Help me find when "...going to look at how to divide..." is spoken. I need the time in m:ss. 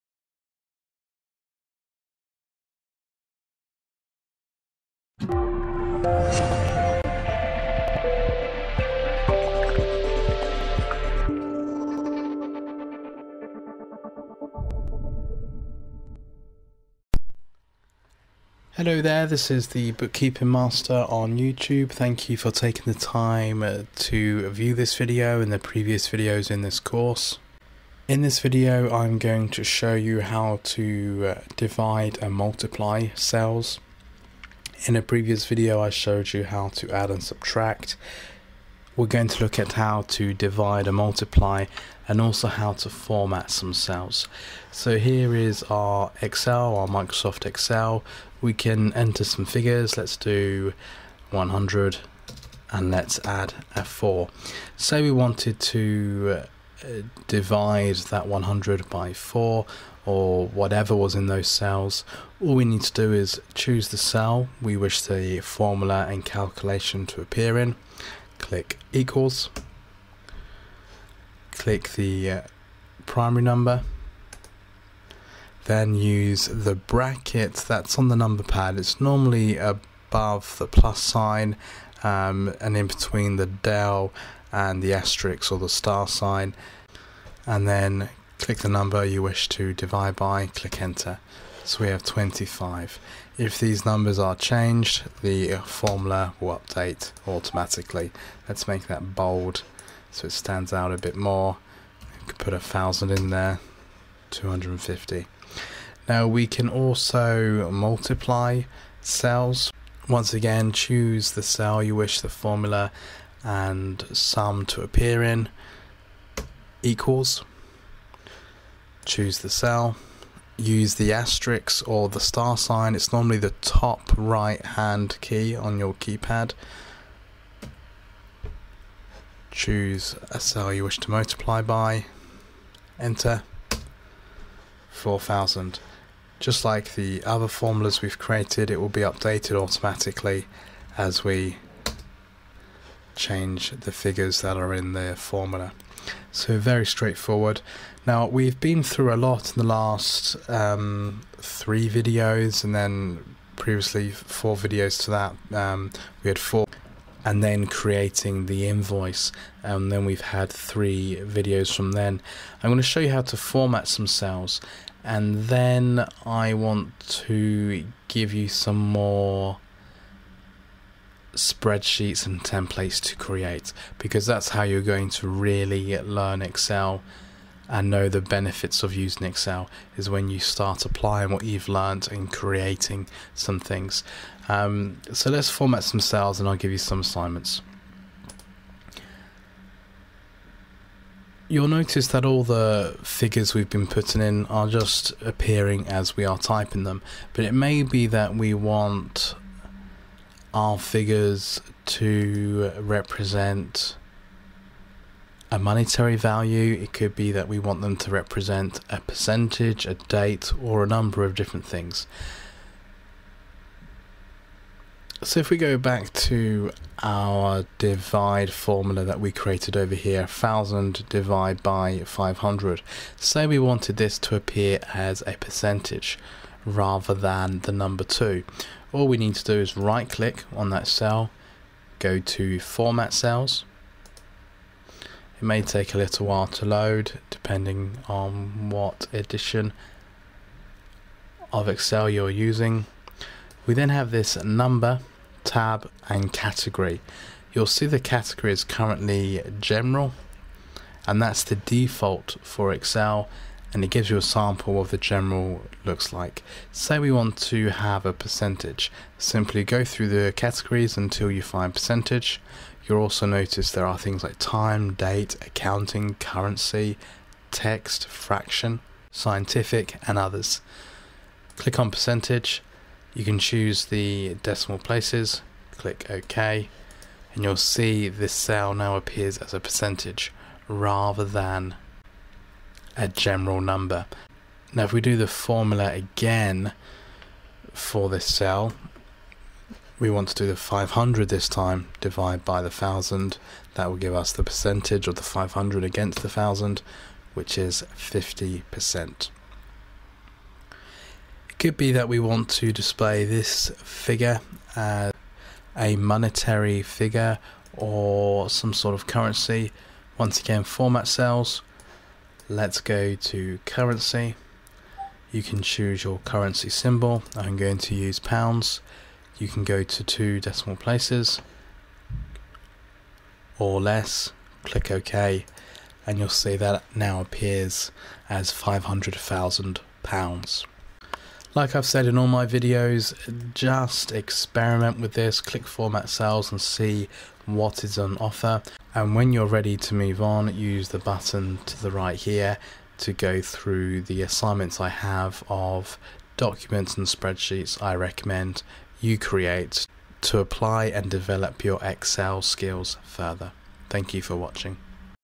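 0:39.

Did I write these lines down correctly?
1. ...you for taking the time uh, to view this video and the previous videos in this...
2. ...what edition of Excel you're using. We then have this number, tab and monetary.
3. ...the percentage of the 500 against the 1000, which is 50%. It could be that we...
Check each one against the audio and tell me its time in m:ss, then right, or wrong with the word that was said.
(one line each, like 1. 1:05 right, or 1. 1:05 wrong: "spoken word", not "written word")
1. 0:22 right
2. 3:58 wrong: "category", not "monetary"
3. 4:54 right.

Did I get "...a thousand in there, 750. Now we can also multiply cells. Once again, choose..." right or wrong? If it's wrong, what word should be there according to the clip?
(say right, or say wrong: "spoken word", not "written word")
wrong: "250", not "750".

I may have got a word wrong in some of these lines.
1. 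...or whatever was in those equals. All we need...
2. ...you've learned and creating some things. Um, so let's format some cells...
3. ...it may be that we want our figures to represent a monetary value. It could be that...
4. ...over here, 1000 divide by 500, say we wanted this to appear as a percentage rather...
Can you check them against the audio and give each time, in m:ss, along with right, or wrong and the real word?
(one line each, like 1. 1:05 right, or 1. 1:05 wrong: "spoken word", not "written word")
1. 1:00 wrong: "cells", not "equals"
2. 3:01 right
3. 3:17 right
4. 3:39 right.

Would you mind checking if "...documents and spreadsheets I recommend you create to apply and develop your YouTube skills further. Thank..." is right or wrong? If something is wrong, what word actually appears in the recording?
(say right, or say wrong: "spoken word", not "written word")
wrong: "Excel", not "YouTube".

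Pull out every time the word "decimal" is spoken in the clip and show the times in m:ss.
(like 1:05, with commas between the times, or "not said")
4:34, 5:20.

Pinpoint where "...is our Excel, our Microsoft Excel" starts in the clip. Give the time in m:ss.
0:45.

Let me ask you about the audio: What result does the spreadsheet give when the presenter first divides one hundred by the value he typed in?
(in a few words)
25.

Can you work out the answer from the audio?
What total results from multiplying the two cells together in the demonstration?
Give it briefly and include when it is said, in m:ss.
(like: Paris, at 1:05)
4000, at 2:14.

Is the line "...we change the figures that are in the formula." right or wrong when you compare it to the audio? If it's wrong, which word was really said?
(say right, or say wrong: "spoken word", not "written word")
right.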